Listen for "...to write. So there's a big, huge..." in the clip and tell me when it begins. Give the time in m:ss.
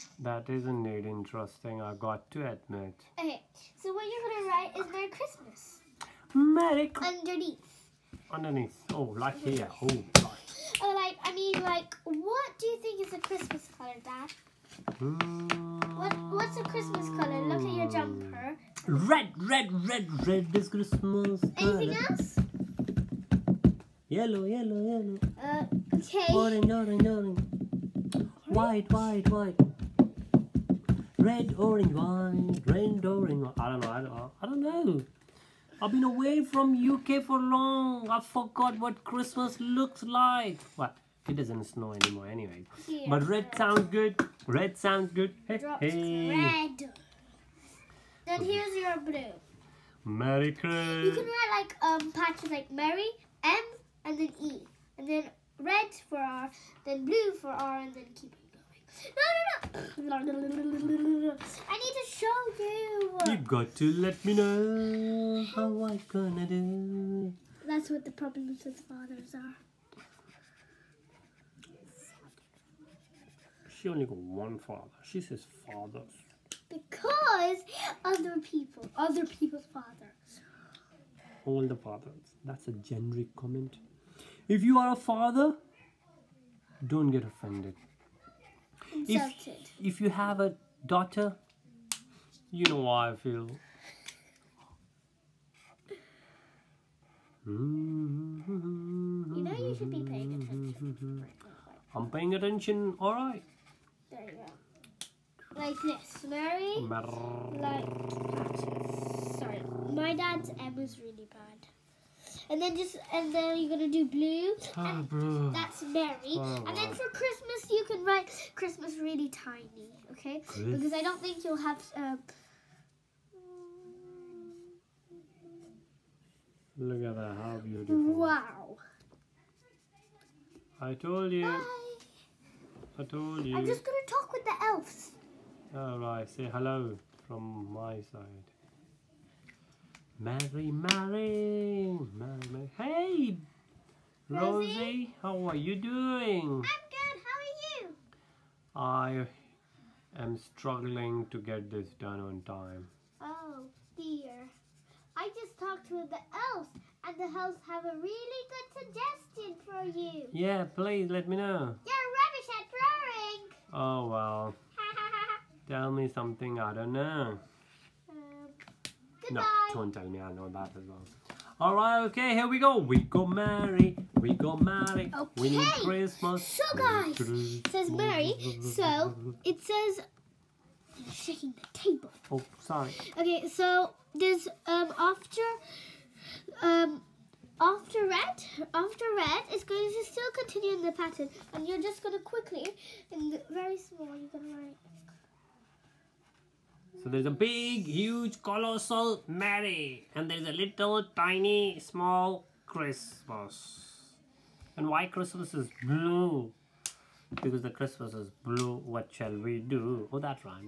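3:14.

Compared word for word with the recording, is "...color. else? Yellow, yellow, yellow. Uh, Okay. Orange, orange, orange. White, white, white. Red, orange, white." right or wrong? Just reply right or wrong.
right.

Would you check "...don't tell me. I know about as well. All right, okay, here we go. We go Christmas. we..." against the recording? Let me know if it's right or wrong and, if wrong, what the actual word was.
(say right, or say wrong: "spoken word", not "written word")
wrong: "Mary", not "Christmas".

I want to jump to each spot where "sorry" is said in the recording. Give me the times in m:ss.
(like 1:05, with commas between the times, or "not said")
1:49, 3:02.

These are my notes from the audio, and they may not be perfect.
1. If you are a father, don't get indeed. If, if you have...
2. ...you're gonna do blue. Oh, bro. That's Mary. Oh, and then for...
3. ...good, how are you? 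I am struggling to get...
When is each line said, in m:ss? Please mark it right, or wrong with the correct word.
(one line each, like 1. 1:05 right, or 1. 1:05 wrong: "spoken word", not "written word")
1. 1:24 wrong: "offended", not "indeed"
2. 1:53 right
3. 2:26 right.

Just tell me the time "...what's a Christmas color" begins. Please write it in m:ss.
0:16.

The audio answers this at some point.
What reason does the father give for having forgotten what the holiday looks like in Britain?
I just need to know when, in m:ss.
0:35.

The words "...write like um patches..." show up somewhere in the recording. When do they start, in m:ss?
0:51.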